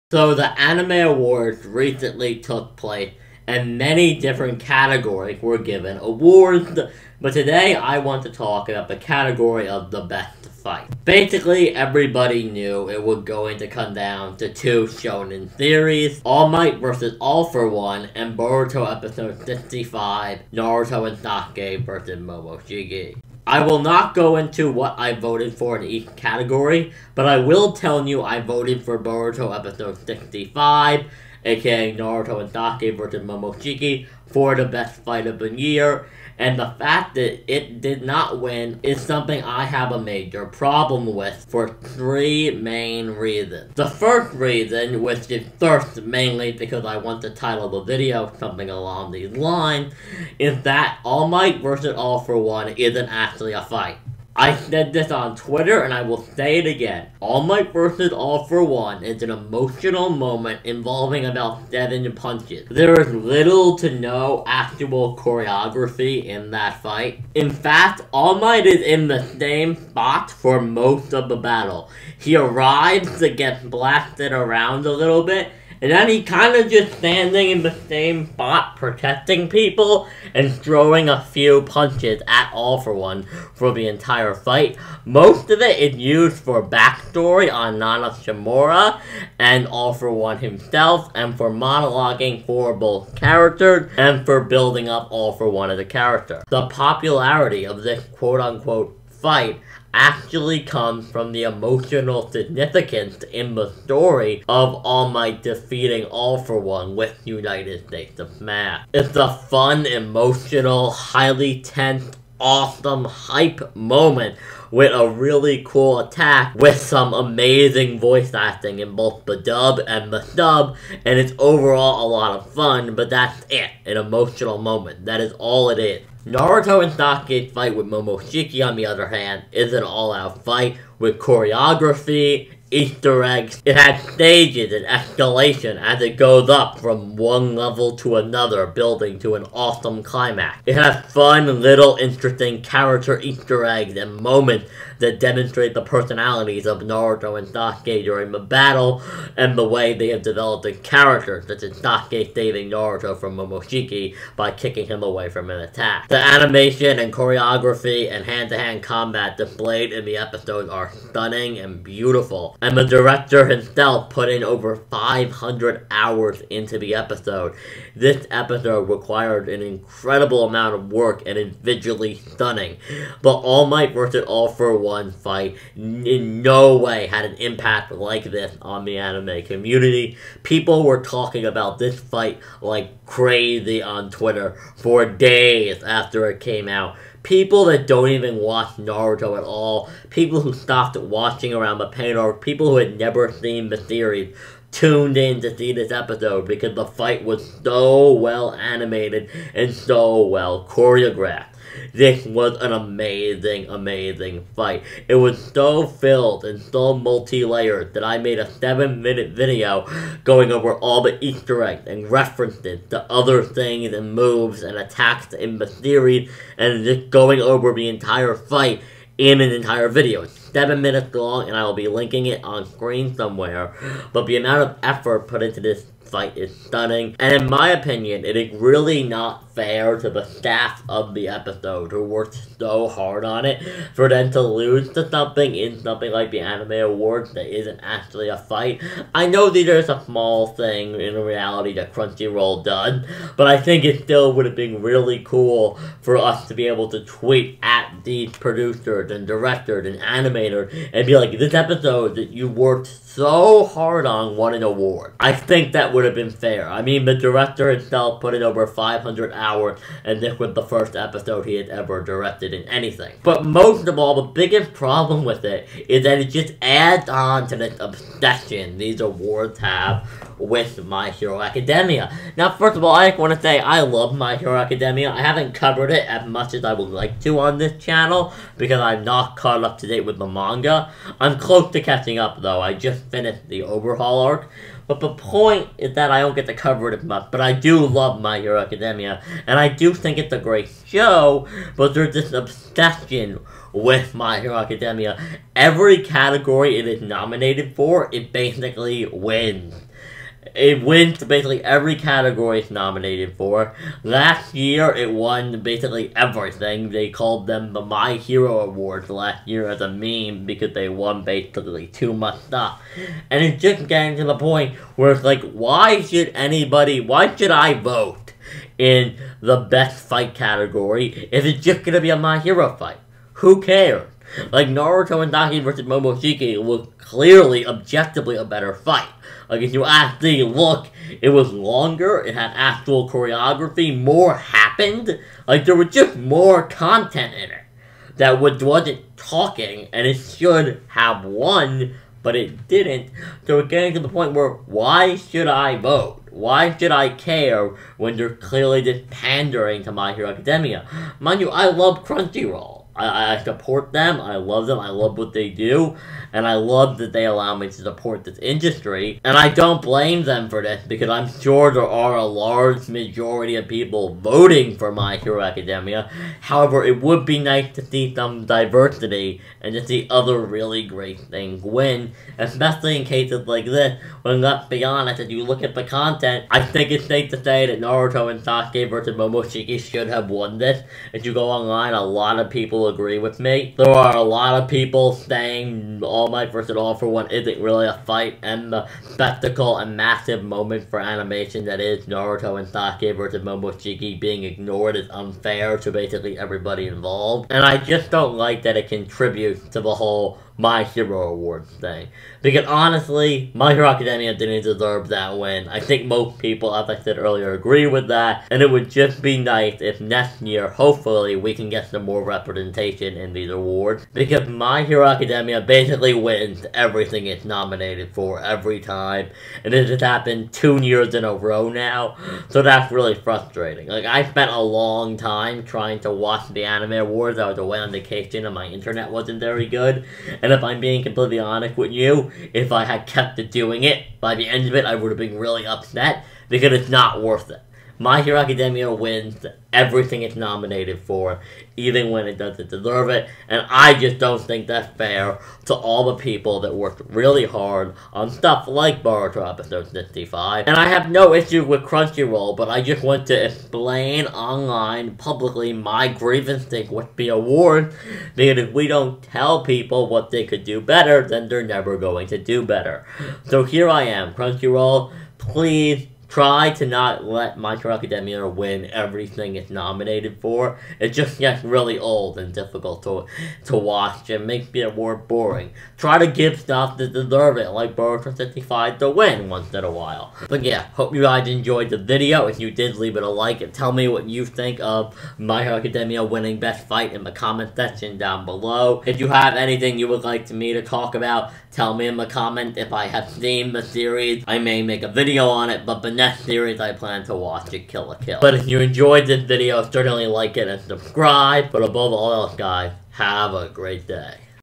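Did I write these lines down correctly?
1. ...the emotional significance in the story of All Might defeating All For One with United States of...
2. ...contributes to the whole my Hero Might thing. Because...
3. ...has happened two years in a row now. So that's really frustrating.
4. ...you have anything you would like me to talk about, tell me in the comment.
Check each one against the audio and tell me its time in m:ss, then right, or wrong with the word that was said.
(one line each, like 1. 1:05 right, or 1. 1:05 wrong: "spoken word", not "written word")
1. 1:41 right
2. 6:38 wrong: "Awards", not "Might"
3. 6:59 right
4. 8:09 right.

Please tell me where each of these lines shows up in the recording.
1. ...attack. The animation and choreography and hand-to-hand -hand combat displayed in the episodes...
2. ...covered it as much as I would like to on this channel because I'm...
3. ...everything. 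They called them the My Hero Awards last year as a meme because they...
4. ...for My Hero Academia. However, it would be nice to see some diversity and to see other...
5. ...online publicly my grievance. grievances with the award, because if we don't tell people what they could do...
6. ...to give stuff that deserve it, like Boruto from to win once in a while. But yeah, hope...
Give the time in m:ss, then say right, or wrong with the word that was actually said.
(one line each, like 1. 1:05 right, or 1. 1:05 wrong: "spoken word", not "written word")
1. 2:35 right
2. 4:35 right
3. 5:06 right
4. 6:04 right
5. 7:34 right
6. 7:56 right.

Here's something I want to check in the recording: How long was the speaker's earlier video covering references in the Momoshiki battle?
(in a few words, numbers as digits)
7 minutes.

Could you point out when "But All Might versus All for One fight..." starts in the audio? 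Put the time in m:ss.
2:53.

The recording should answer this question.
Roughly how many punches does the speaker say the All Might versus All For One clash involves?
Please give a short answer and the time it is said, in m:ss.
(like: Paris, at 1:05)
7, at 1:01.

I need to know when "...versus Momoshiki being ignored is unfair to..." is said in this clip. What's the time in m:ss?
6:33.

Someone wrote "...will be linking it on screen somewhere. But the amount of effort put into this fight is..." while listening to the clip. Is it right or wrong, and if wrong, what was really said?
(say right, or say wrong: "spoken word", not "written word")
right.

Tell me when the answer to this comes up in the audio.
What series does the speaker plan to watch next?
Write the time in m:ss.
8:17.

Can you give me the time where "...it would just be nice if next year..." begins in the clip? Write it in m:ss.
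6:48.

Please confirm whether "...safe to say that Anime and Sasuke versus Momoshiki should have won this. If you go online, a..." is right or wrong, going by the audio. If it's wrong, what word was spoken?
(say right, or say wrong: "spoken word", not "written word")
wrong: "Naruto", not "Anime".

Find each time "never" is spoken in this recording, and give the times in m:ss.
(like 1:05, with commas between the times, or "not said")
3:12, 7:41.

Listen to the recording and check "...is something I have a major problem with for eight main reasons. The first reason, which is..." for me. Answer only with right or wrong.
wrong.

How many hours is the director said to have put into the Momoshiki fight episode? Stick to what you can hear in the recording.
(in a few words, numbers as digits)
over 500.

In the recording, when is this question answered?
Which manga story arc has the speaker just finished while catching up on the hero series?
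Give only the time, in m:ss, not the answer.
4:43.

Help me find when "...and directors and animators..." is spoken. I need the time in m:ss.
4:09.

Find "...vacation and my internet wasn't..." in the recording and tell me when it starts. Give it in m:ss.
7:07.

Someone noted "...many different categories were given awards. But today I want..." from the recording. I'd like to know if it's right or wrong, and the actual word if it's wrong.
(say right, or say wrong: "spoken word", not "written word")
right.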